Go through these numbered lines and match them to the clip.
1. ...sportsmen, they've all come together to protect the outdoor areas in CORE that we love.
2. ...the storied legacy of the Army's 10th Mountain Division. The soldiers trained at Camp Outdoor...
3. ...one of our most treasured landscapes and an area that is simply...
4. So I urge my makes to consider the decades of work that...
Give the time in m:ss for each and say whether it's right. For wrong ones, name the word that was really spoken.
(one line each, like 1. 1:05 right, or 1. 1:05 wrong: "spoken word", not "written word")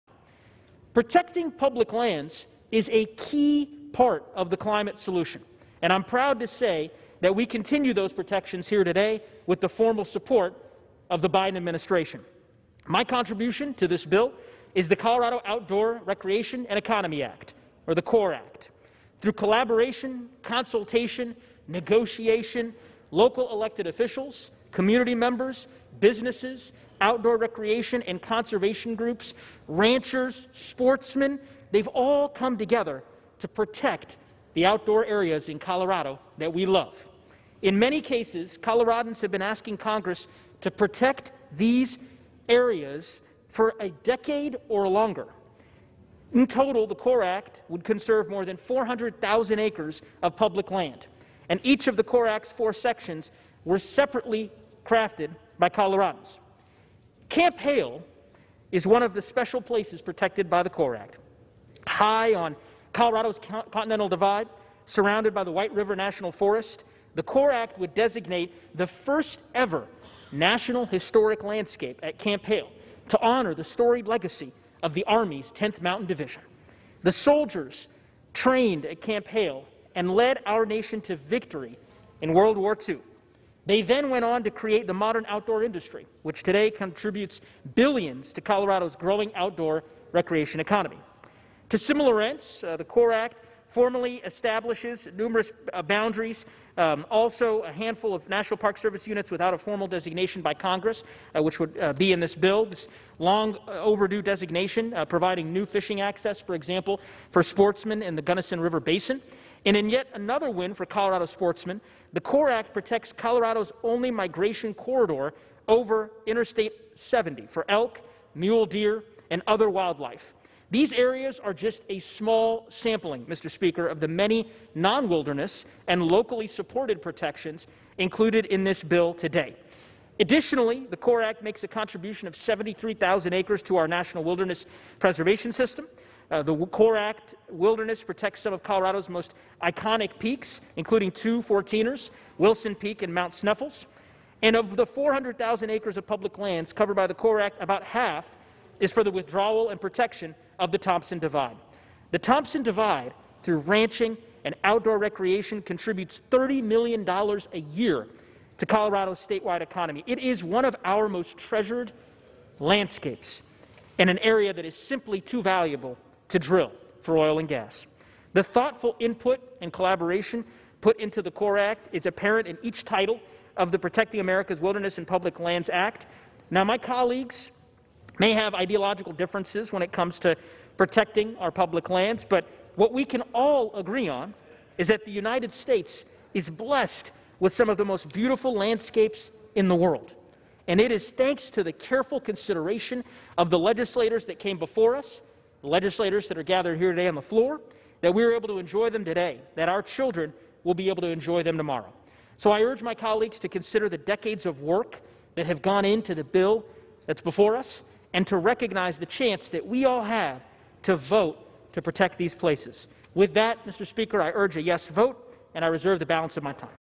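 1. 0:30 wrong: "Colorado", not "CORE"
2. 1:13 wrong: "Hale", not "Outdoor"
3. 2:40 right
4. 3:22 wrong: "colleagues", not "makes".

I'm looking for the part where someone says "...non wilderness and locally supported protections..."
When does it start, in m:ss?
2:04.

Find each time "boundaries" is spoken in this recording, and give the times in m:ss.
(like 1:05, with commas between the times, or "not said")
1:35.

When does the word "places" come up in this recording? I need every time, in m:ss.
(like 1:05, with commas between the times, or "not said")
0:59, 3:32.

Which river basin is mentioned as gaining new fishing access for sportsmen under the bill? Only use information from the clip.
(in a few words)
Gunnison River Basin.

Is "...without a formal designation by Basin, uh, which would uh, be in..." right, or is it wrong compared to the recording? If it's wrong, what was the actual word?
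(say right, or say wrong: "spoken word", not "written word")
wrong: "Congress", not "Basin".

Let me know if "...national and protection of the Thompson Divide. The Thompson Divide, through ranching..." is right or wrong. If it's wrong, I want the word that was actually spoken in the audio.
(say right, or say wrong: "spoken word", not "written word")
wrong: "withdrawal", not "national".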